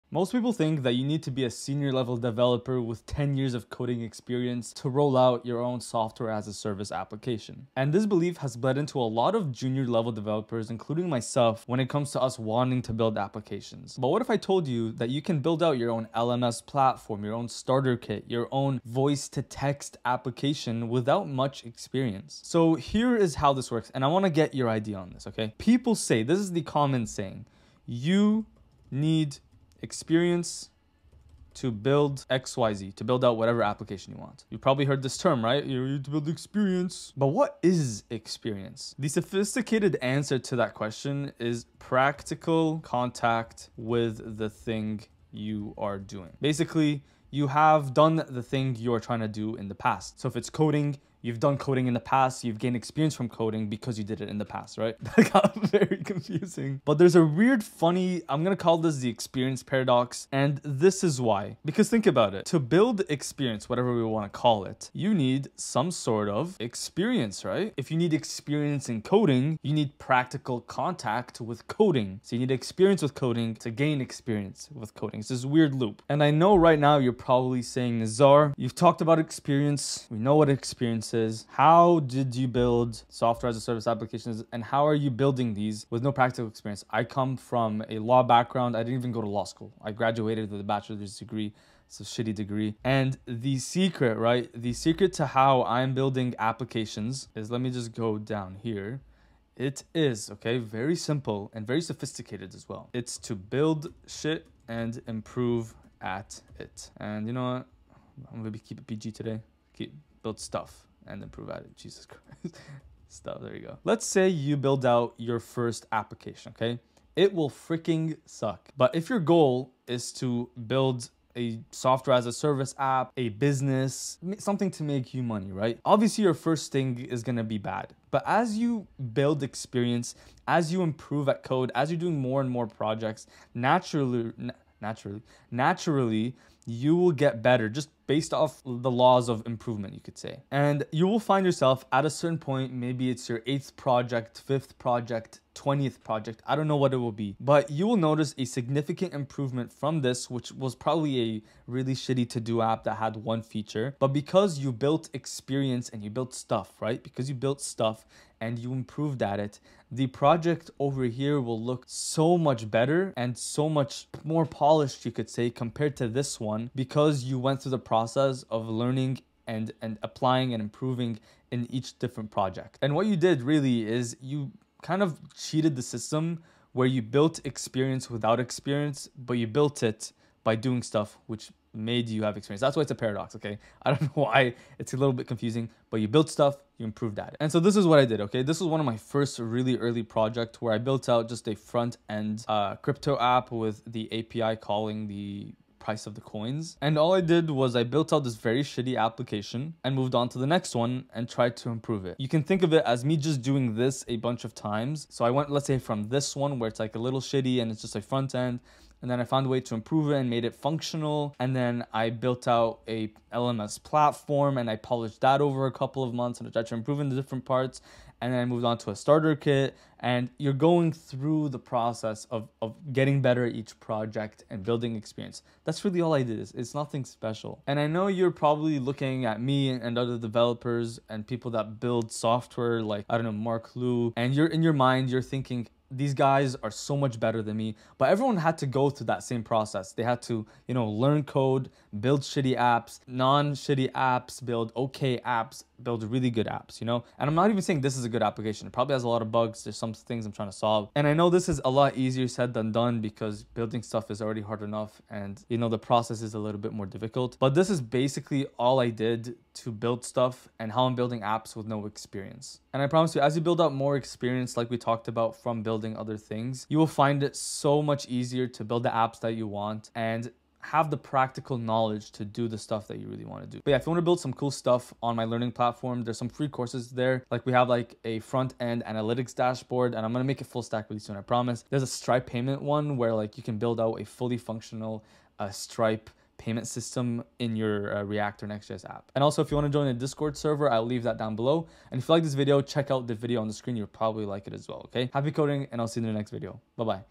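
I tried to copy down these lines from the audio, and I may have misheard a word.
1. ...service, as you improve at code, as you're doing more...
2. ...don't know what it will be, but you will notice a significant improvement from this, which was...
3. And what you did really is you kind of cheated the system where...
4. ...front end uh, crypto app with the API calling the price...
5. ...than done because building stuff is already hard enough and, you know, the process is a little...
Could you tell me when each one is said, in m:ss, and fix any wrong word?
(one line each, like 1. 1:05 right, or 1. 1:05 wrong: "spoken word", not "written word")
1. 2:09 wrong: "experience", not "service"
2. 2:26 right
3. 2:52 right
4. 3:11 right
5. 4:12 right.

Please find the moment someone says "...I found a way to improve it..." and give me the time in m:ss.
3:29.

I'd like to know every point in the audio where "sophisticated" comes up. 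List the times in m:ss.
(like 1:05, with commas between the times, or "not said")
0:39, 1:41.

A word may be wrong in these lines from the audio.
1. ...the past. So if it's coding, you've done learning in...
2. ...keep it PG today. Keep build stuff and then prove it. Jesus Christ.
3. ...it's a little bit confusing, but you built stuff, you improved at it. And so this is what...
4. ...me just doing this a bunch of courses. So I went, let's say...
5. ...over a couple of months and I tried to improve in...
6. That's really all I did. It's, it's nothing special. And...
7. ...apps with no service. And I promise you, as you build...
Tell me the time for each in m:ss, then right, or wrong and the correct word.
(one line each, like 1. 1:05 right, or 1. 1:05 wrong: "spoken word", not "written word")
1. 0:49 wrong: "coding", not "learning"
2. 1:48 right
3. 3:04 right
4. 3:23 wrong: "times", not "courses"
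5. 3:35 right
6. 3:45 right
7. 4:21 wrong: "experience", not "service".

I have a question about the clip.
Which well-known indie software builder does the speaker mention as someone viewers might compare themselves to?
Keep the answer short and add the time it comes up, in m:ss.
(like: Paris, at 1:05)
Marc Lou, at 3:53.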